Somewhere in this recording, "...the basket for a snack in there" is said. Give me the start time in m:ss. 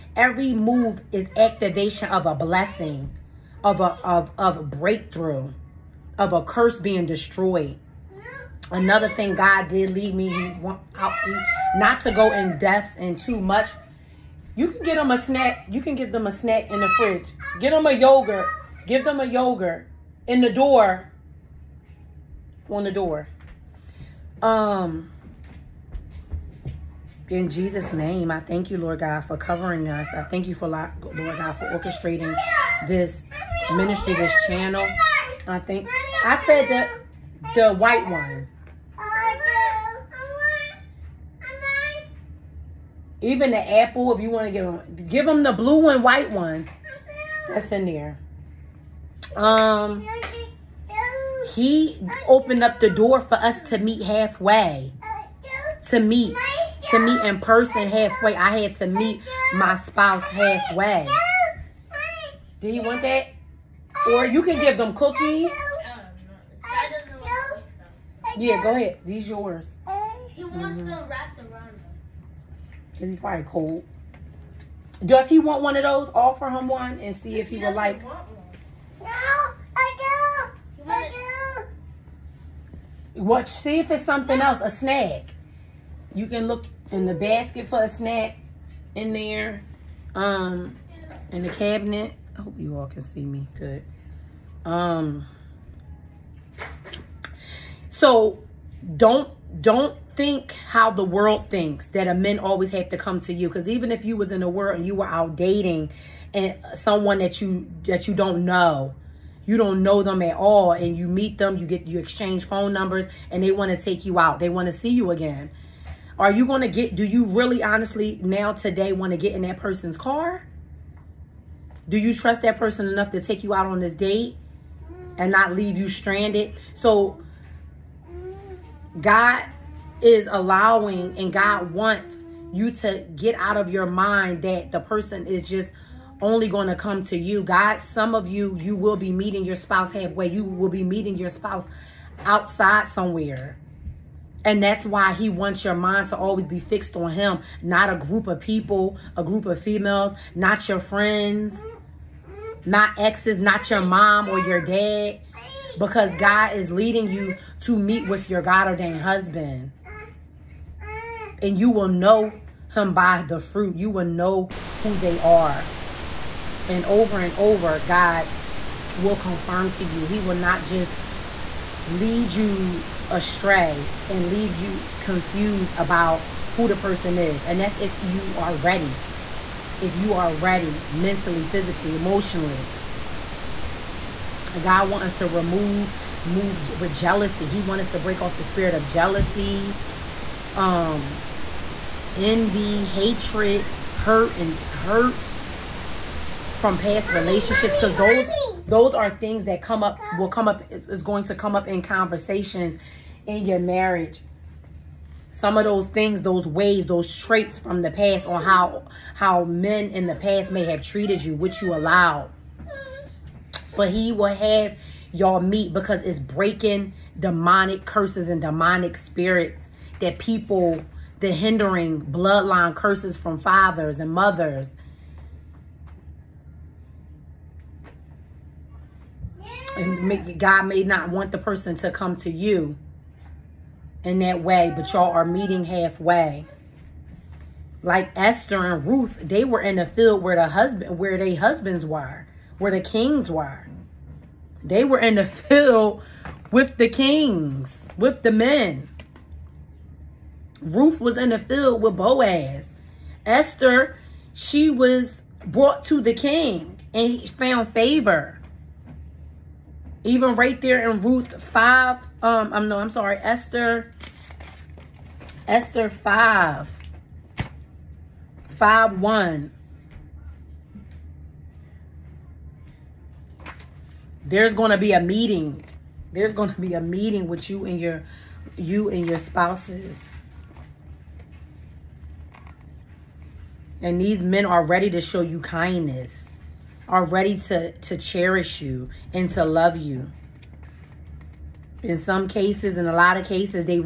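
1:27.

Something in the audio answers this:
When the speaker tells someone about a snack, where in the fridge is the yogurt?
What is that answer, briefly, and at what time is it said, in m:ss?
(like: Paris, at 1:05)
on the door, at 0:22.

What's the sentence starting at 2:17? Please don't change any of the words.
God, some of you, you will be meeting your spouse halfway.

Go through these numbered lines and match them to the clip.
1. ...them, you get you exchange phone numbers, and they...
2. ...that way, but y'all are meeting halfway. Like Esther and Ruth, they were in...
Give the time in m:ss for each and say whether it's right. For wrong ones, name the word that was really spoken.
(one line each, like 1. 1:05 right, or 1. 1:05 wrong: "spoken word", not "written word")
1. 1:51 right
2. 3:54 right.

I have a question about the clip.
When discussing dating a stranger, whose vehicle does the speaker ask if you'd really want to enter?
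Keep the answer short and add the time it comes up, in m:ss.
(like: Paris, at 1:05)
that person's car, at 1:59.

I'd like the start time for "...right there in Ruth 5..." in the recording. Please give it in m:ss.
4:20.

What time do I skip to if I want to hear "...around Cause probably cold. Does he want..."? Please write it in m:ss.
1:11.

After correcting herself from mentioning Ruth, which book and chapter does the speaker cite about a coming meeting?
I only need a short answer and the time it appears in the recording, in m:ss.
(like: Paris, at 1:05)
Esther 5, at 4:25.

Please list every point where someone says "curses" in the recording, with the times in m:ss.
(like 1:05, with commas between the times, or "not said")
0:06, 3:37, 3:42.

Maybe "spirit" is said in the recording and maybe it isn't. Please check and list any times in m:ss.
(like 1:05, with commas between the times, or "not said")
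3:08, 3:38.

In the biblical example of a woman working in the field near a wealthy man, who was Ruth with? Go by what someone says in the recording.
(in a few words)
Boaz.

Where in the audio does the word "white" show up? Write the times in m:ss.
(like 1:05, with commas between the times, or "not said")
0:37, 0:46.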